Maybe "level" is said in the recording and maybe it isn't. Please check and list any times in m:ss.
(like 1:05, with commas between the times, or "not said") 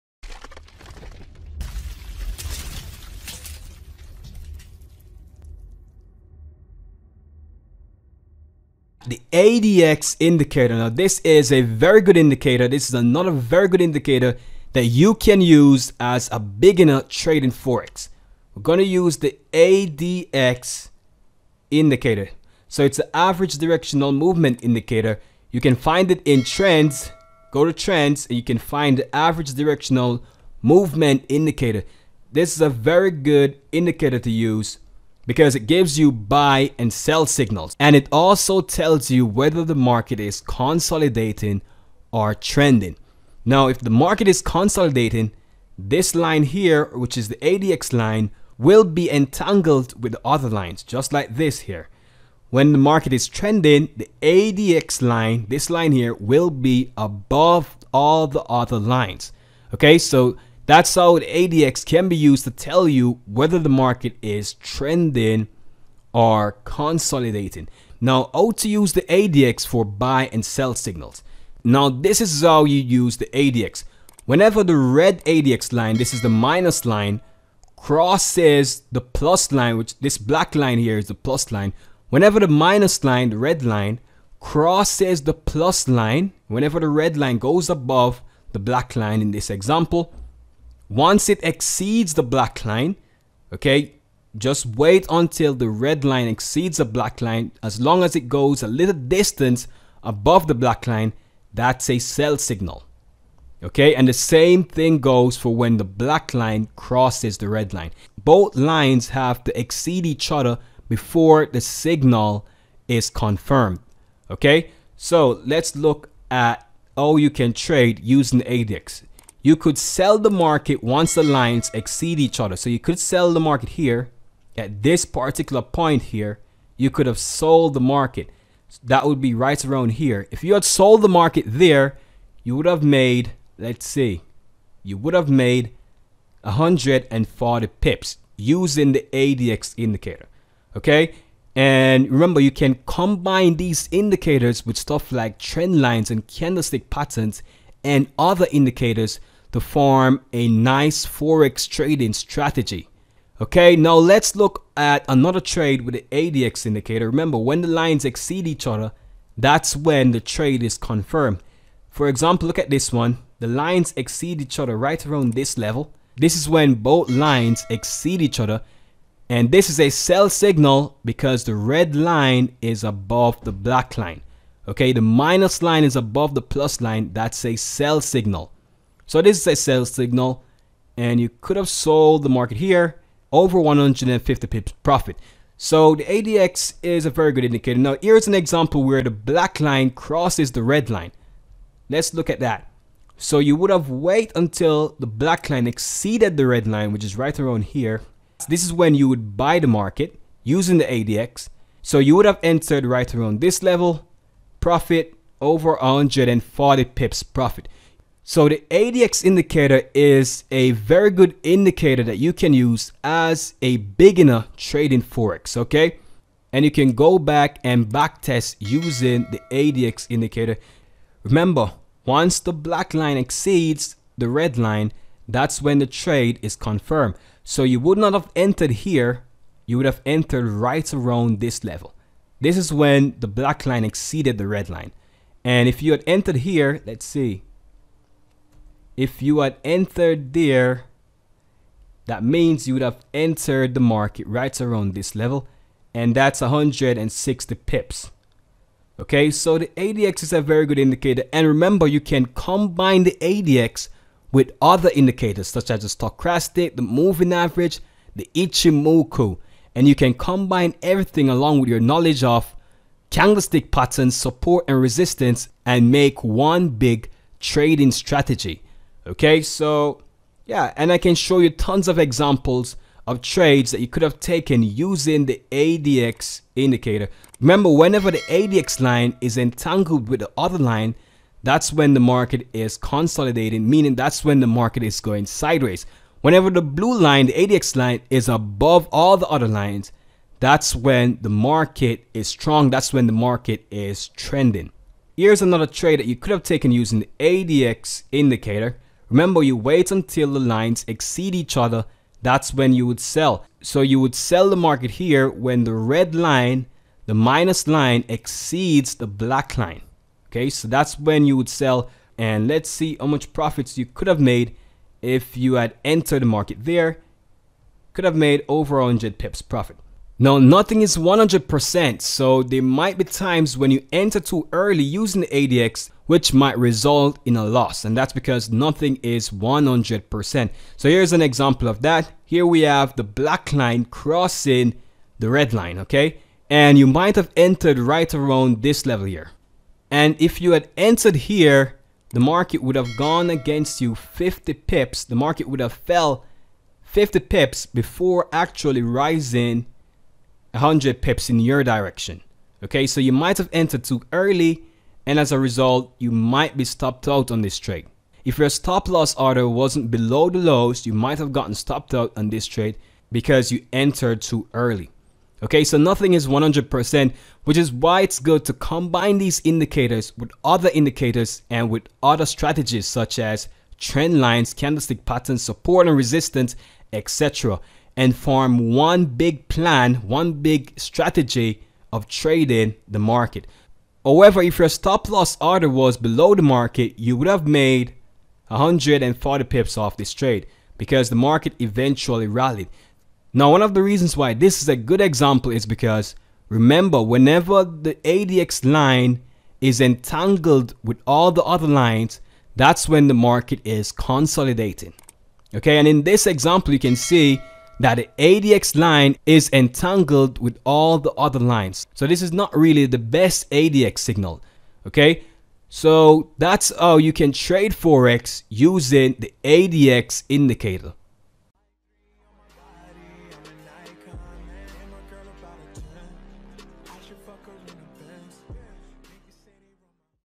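2:45, 3:23, 3:51, 4:05, 5:38.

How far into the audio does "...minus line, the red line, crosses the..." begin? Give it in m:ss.
1:22.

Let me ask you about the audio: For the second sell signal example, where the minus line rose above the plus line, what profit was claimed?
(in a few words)
Over 150 pips.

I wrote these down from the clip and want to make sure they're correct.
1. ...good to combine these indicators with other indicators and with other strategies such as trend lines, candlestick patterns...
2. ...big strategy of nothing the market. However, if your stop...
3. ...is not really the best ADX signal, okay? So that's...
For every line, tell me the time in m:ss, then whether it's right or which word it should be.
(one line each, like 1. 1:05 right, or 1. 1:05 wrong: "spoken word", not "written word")
1. 6:08 right
2. 6:20 wrong: "trading", not "nothing"
3. 6:52 right.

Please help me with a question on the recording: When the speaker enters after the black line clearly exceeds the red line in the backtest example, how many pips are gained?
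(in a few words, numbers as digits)
160 pips.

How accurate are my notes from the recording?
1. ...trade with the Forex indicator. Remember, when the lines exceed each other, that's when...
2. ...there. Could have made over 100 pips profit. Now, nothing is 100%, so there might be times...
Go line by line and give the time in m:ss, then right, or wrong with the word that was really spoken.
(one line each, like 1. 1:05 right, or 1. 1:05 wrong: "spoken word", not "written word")
1. 2:35 wrong: "ADX", not "Forex"
2. 5:16 right.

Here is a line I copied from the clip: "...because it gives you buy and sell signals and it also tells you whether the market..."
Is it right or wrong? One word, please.
right.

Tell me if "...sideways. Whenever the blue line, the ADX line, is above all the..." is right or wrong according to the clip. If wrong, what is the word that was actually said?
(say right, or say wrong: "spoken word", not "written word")
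right.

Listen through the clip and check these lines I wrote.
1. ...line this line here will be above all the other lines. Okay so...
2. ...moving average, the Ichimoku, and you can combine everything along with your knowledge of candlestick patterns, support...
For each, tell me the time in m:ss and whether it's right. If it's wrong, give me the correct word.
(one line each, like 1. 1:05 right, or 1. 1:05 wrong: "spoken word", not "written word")
1. 0:55 right
2. 4:16 right.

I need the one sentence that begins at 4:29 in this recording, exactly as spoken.
Okay, so yeah, and I can show you tons of examples of trades that you could have taken using the ADX indicator.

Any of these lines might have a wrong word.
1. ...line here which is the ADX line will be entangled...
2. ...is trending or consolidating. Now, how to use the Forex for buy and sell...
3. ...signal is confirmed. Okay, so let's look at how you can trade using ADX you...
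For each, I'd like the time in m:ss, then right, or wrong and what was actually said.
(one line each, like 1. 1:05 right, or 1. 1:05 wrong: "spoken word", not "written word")
1. 0:46 right
2. 1:04 wrong: "ADX", not "Forex"
3. 1:51 right.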